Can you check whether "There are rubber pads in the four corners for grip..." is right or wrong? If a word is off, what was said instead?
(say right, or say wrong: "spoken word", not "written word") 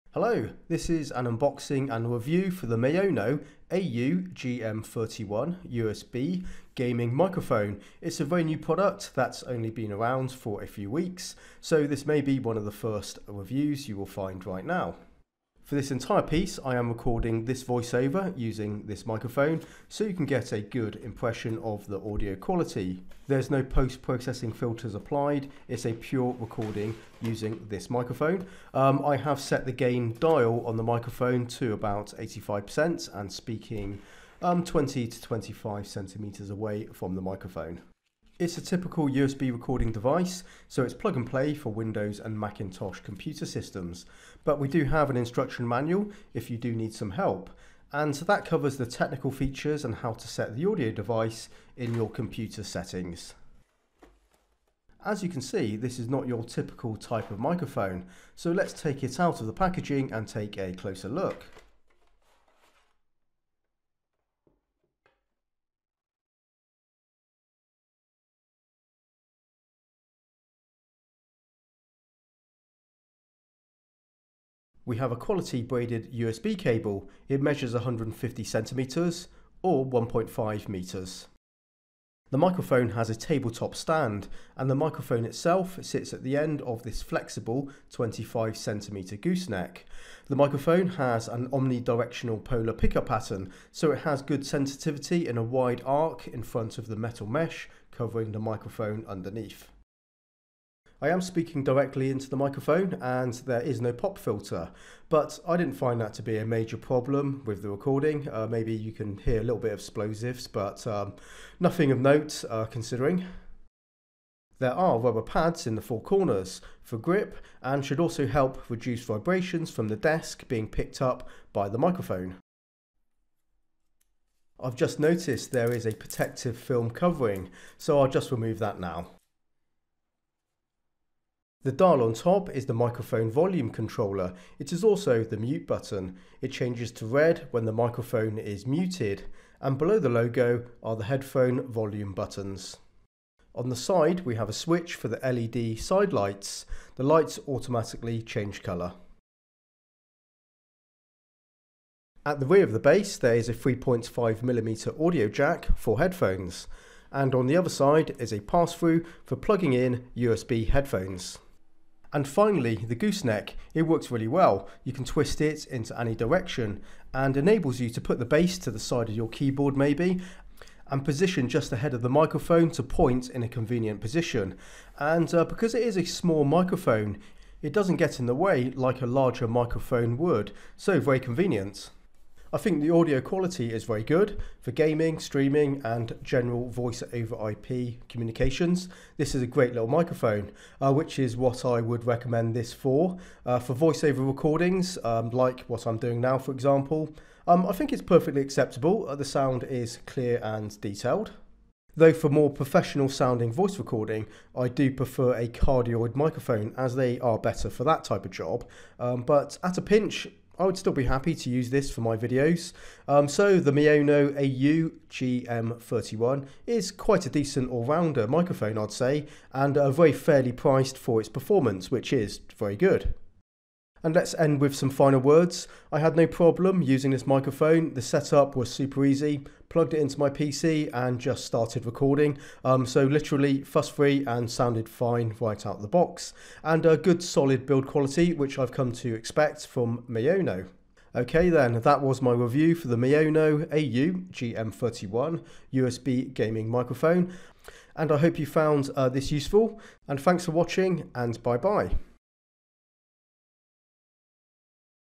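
right.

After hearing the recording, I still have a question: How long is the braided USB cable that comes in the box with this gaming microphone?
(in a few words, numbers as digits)
1.5 meters.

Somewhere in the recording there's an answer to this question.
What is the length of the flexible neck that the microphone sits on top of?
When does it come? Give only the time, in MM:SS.
01:27.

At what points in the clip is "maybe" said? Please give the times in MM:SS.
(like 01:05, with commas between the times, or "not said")
01:48, 02:49.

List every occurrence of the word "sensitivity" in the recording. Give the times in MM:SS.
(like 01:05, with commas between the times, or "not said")
01:34.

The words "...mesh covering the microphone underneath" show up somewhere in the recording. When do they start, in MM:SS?
01:37.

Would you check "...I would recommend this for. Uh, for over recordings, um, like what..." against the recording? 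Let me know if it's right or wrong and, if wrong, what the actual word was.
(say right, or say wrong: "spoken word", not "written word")
right.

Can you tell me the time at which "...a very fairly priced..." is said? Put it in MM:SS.
03:39.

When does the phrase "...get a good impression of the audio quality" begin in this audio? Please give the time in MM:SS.
00:20.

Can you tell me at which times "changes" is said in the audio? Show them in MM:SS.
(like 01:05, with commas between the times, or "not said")
02:16, 02:28.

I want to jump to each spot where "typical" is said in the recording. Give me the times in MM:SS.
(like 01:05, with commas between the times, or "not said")
00:38, 00:56.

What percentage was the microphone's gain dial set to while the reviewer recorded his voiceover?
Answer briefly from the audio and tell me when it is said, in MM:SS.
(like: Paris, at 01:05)
85%, at 00:32.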